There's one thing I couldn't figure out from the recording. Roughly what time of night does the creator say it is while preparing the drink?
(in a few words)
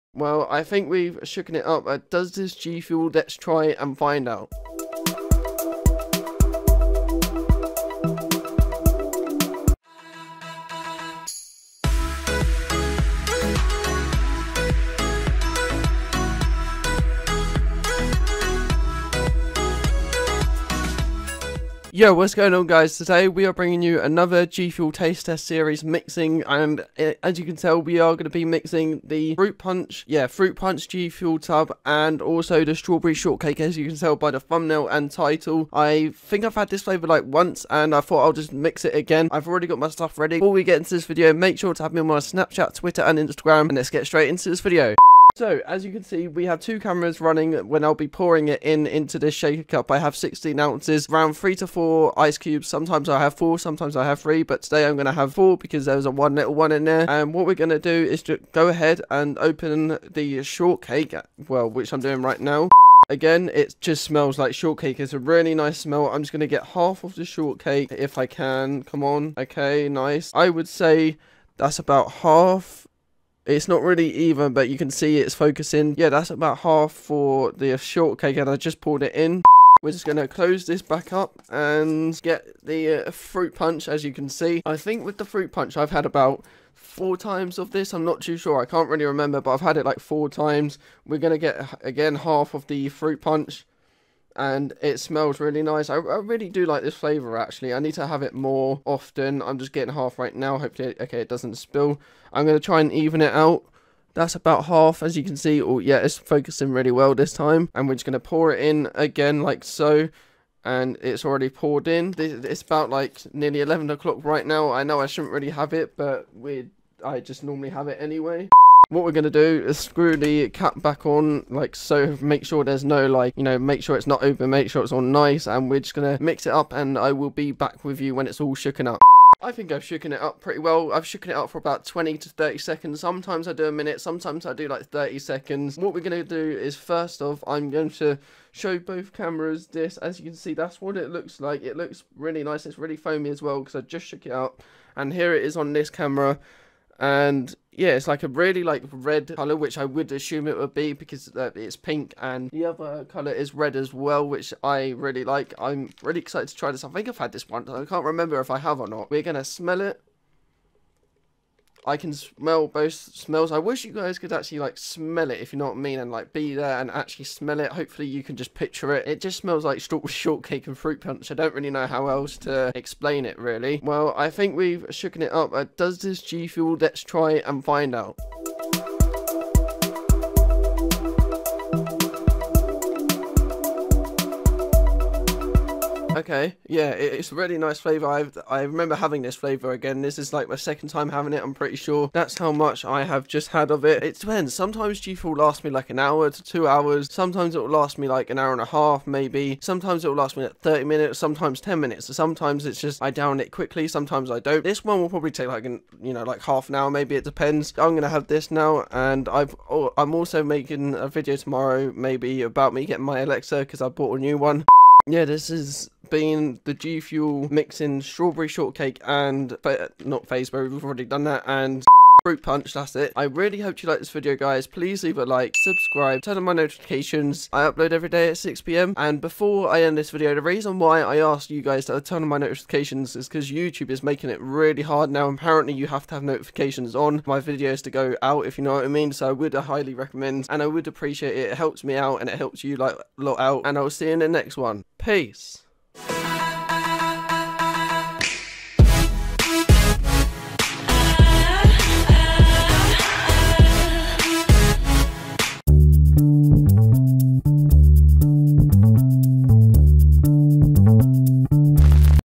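nearly 11 o'clock.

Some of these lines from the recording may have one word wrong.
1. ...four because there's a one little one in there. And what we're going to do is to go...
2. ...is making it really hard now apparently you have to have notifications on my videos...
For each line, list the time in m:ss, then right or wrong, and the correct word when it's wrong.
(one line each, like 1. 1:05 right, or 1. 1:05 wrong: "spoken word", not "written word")
1. 0:55 right
2. 3:53 right.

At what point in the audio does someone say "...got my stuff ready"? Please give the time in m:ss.
0:39.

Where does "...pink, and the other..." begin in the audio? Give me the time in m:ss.
2:31.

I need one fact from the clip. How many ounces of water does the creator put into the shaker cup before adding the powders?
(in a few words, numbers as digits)
16.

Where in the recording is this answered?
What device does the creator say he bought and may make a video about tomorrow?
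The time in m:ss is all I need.
3:33.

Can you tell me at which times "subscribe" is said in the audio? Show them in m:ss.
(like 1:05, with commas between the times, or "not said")
3:45.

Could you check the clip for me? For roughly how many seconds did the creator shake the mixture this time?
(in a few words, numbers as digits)
20 to 30 seconds.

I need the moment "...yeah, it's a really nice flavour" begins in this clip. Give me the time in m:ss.
3:06.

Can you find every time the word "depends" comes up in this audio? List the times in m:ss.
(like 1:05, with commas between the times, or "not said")
3:14, 3:27.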